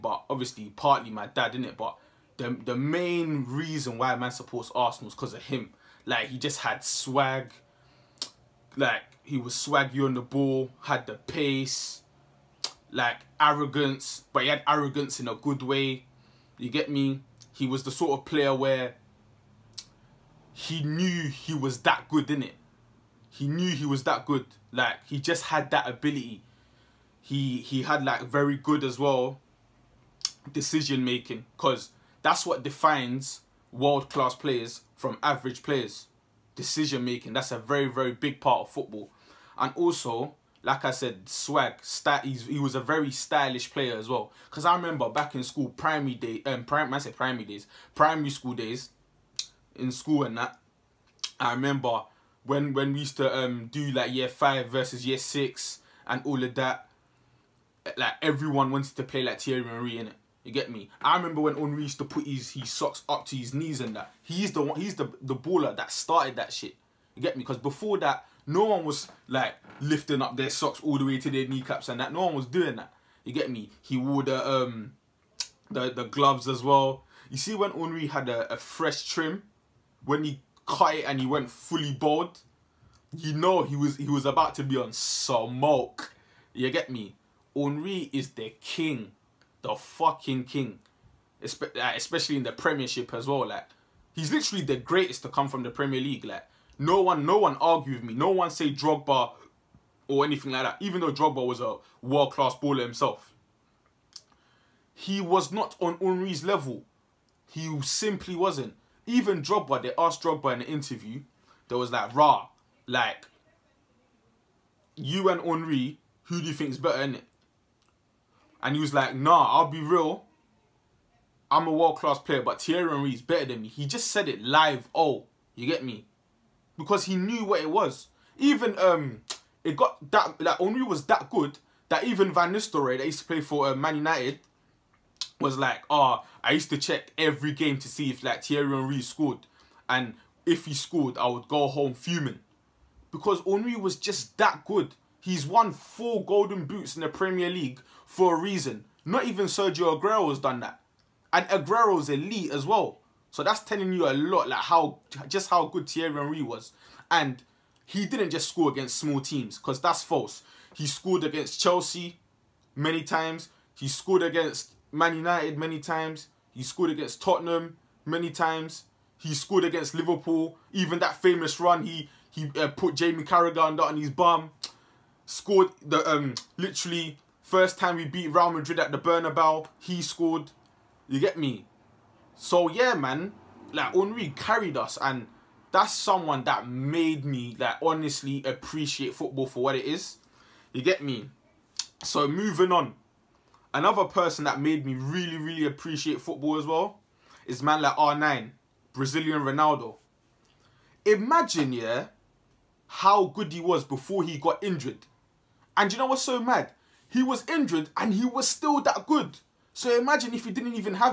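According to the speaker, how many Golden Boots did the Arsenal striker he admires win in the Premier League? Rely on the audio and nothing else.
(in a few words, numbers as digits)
4.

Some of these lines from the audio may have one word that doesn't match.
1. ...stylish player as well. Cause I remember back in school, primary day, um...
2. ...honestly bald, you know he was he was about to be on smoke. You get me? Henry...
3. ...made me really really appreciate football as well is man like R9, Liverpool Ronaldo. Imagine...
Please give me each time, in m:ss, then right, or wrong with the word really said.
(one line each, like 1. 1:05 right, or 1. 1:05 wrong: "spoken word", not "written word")
1. 0:43 right
2. 1:21 wrong: "fully", not "honestly"
3. 3:14 wrong: "Brazilian", not "Liverpool".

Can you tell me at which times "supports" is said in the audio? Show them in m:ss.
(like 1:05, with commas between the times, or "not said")
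0:04.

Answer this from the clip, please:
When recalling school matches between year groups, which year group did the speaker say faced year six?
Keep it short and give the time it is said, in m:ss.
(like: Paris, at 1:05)
Year 5, at 0:54.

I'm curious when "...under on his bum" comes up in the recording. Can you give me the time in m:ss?
2:53.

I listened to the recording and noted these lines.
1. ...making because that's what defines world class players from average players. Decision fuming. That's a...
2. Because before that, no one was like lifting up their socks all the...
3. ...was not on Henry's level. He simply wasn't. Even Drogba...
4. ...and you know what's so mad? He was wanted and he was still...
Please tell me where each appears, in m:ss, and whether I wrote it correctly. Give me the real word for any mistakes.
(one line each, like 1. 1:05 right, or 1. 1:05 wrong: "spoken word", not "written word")
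1. 0:31 wrong: "making", not "fuming"
2. 1:07 right
3. 1:45 right
4. 3:25 wrong: "injured", not "wanted".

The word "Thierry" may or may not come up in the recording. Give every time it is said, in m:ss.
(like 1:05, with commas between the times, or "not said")
0:59, 2:02, 2:18, 2:35.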